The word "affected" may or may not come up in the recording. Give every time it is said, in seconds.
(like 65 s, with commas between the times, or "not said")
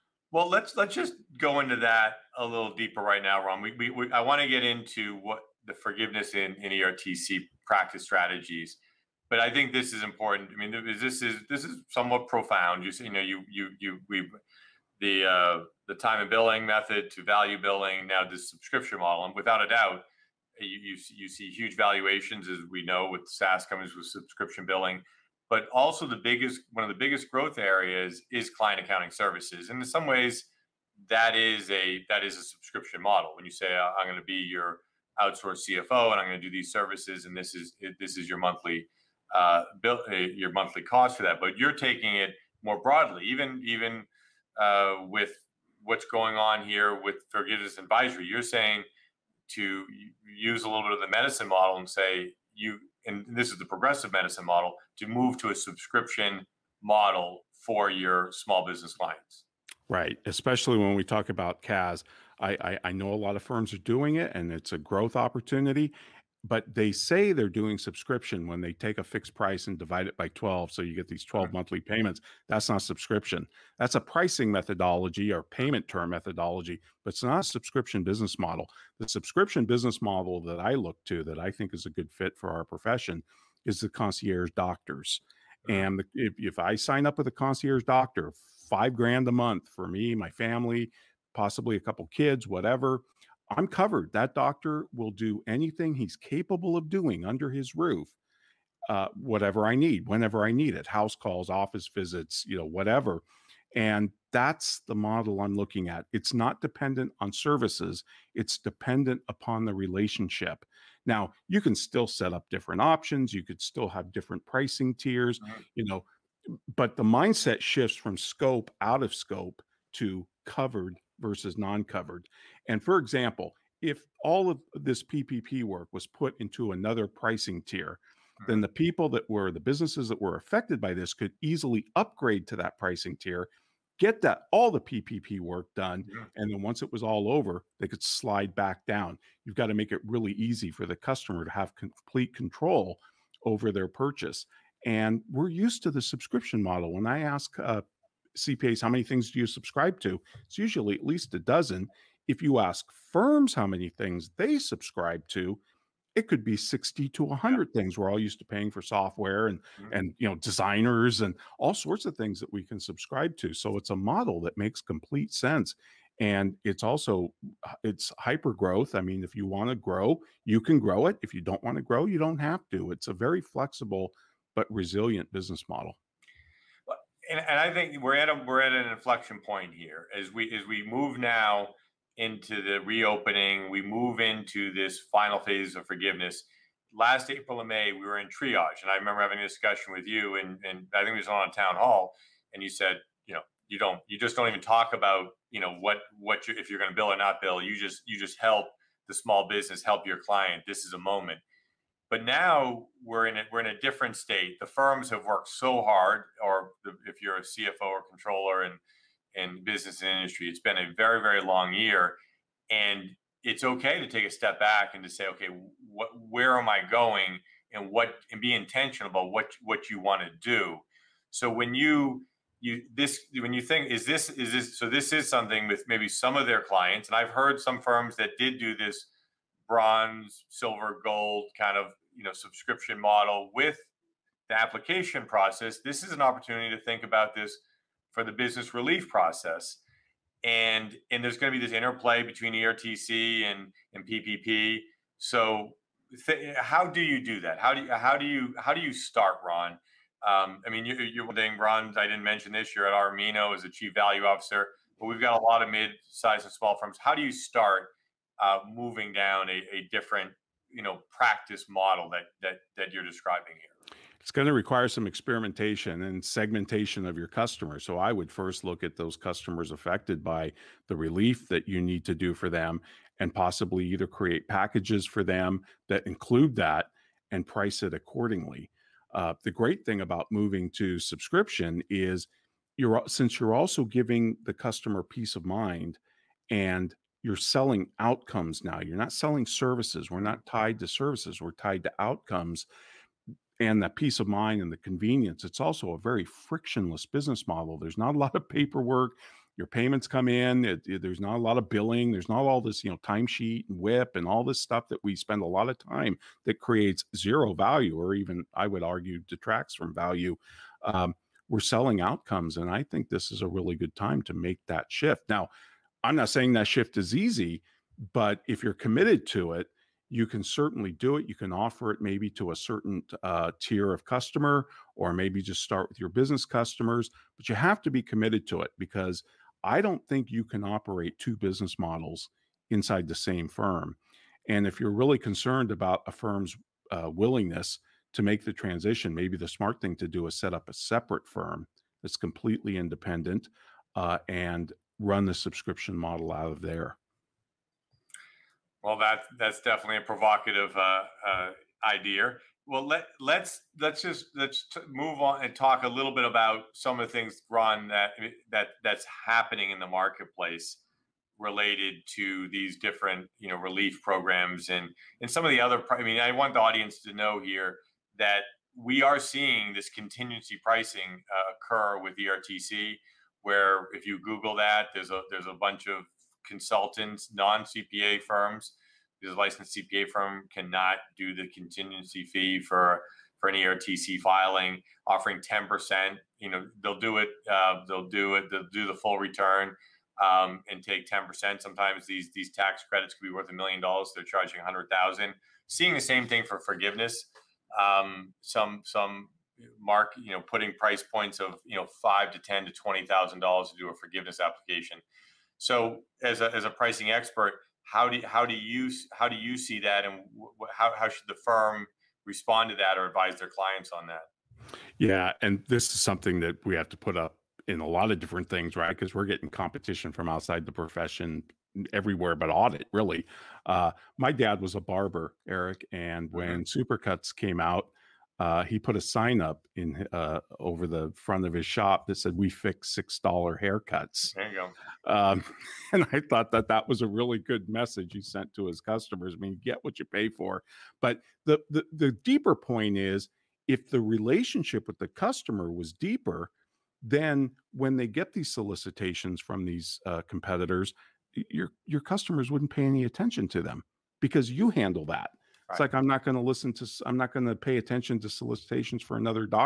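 130 s, 269 s.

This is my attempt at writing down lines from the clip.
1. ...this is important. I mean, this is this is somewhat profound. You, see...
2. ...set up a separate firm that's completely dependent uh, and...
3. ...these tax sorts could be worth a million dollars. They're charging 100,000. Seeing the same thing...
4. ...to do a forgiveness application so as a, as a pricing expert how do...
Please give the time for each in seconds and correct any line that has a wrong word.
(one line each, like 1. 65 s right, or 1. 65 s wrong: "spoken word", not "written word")
1. 9 s right
2. 340 s wrong: "independent", not "dependent"
3. 392 s wrong: "credits", not "sorts"
4. 403 s right.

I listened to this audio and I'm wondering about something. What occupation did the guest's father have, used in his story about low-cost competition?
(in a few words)
barber.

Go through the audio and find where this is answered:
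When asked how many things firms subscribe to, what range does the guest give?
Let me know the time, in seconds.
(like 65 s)
156 s.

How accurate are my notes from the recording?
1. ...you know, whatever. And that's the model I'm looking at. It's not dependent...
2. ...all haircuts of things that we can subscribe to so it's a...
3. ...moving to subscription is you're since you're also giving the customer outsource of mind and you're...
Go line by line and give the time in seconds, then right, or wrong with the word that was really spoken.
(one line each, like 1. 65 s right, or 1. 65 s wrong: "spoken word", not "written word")
1. 102 s right
2. 161 s wrong: "sorts", not "haircuts"
3. 280 s wrong: "peace", not "outsource".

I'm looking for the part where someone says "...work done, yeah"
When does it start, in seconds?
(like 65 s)
135 s.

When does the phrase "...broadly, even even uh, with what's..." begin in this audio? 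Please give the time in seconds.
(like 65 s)
42 s.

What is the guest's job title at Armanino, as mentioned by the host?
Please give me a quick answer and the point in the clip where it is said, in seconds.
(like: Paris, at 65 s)
chief value officer, at 253 s.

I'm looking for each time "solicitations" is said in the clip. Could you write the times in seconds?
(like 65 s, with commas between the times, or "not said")
448 s, 458 s.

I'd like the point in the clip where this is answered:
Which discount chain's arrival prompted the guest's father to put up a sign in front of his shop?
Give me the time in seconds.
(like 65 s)
426 s.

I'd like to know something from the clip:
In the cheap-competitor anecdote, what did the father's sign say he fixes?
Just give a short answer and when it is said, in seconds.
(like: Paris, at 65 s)
six dollar haircuts, at 432 s.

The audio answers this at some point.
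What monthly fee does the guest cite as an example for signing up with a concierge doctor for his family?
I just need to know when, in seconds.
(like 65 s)
88 s.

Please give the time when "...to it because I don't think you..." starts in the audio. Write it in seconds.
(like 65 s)
328 s.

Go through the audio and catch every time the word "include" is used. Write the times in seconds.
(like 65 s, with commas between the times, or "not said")
276 s.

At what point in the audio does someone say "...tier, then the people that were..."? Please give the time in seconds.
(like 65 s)
127 s.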